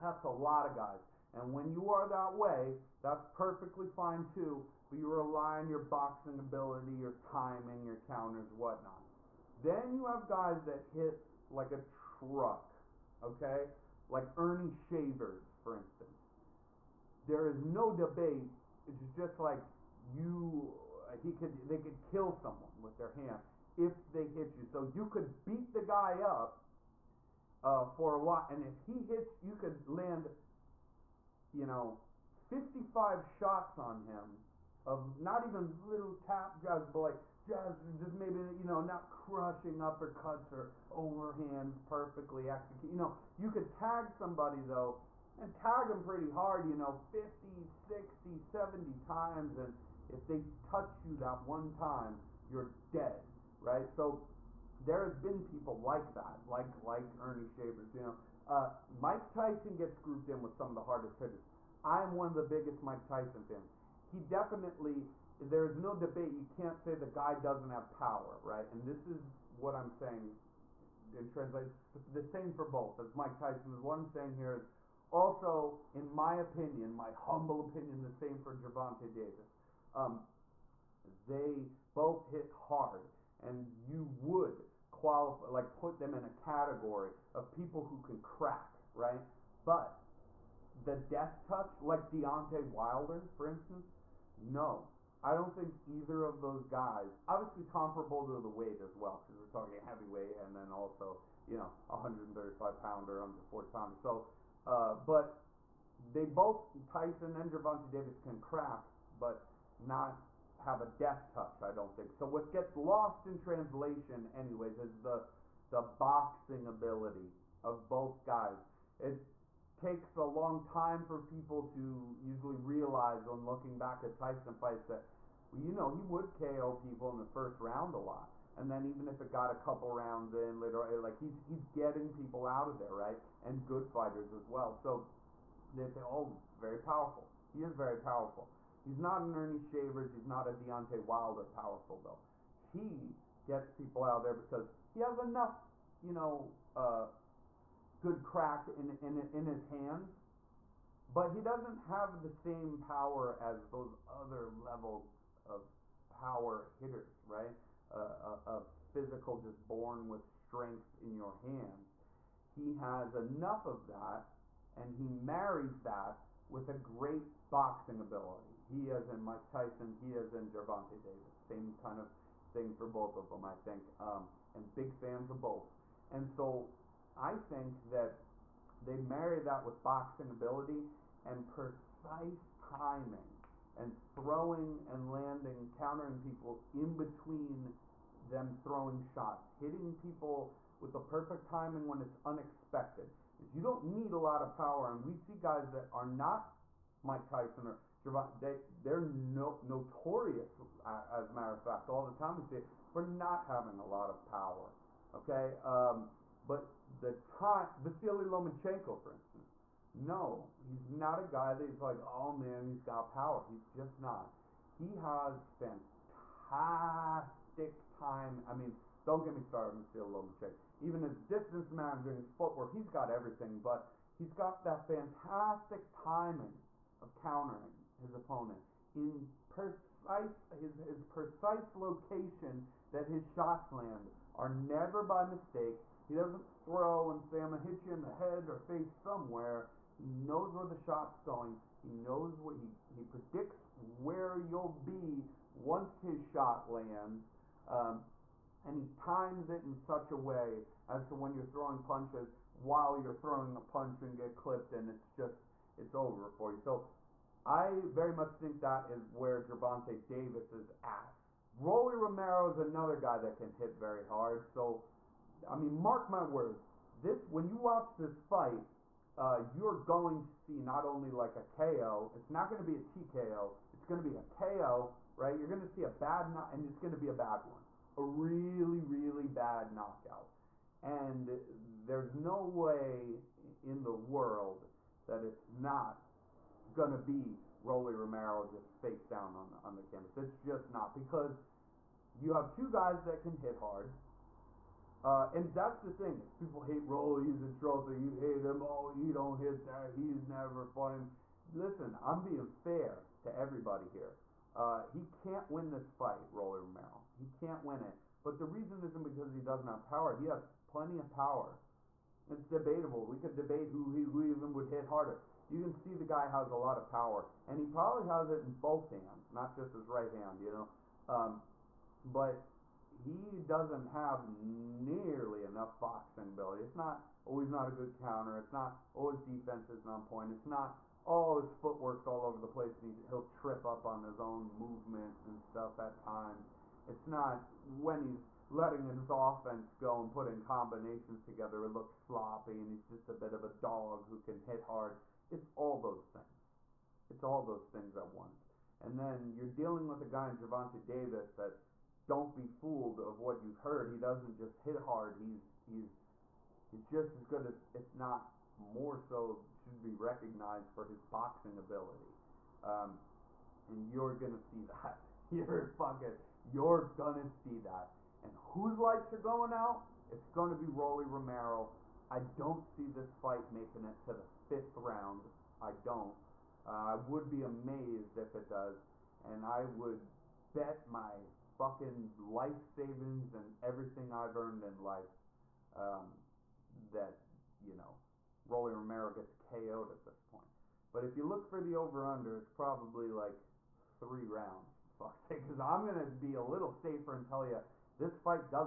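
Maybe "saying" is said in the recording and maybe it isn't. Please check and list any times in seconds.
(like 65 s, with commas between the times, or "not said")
69 s, 74 s.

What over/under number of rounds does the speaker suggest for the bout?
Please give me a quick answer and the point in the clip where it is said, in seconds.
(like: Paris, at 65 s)
3, at 393 s.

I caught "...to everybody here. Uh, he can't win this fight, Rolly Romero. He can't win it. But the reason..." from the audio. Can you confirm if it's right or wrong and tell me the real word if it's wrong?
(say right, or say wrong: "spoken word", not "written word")
right.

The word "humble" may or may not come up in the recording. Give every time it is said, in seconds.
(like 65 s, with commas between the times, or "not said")
77 s.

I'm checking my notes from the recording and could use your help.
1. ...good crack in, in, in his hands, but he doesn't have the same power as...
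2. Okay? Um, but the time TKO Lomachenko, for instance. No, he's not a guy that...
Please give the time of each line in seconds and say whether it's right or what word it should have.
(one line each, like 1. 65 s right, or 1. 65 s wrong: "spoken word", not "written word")
1. 148 s right
2. 205 s wrong: "Vasily", not "TKO".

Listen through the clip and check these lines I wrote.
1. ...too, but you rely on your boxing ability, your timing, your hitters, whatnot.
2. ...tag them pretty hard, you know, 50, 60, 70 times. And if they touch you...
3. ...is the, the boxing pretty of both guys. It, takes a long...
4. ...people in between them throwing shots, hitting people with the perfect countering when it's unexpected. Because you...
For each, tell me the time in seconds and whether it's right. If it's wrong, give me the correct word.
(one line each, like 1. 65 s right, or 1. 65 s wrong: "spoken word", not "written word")
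1. 4 s wrong: "counters", not "hitters"
2. 45 s right
3. 114 s wrong: "ability", not "pretty"
4. 186 s wrong: "timing", not "countering".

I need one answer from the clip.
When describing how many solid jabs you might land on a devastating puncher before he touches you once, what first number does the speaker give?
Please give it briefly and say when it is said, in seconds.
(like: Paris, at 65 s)
55, at 32 s.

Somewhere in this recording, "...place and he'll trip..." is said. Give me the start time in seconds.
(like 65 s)
332 s.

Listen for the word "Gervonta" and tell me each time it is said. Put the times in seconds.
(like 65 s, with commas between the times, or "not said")
78 s, 107 s, 170 s, 259 s, 350 s.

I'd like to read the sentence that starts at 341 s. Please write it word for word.
It looks sloppy, and he's just a bit of a dog who can hit hard.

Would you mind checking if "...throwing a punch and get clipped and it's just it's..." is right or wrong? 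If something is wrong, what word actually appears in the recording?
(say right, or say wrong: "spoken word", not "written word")
right.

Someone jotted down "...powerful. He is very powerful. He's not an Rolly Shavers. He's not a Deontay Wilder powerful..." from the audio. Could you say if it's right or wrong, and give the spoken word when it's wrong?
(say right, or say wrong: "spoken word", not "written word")
wrong: "Ernie", not "Rolly".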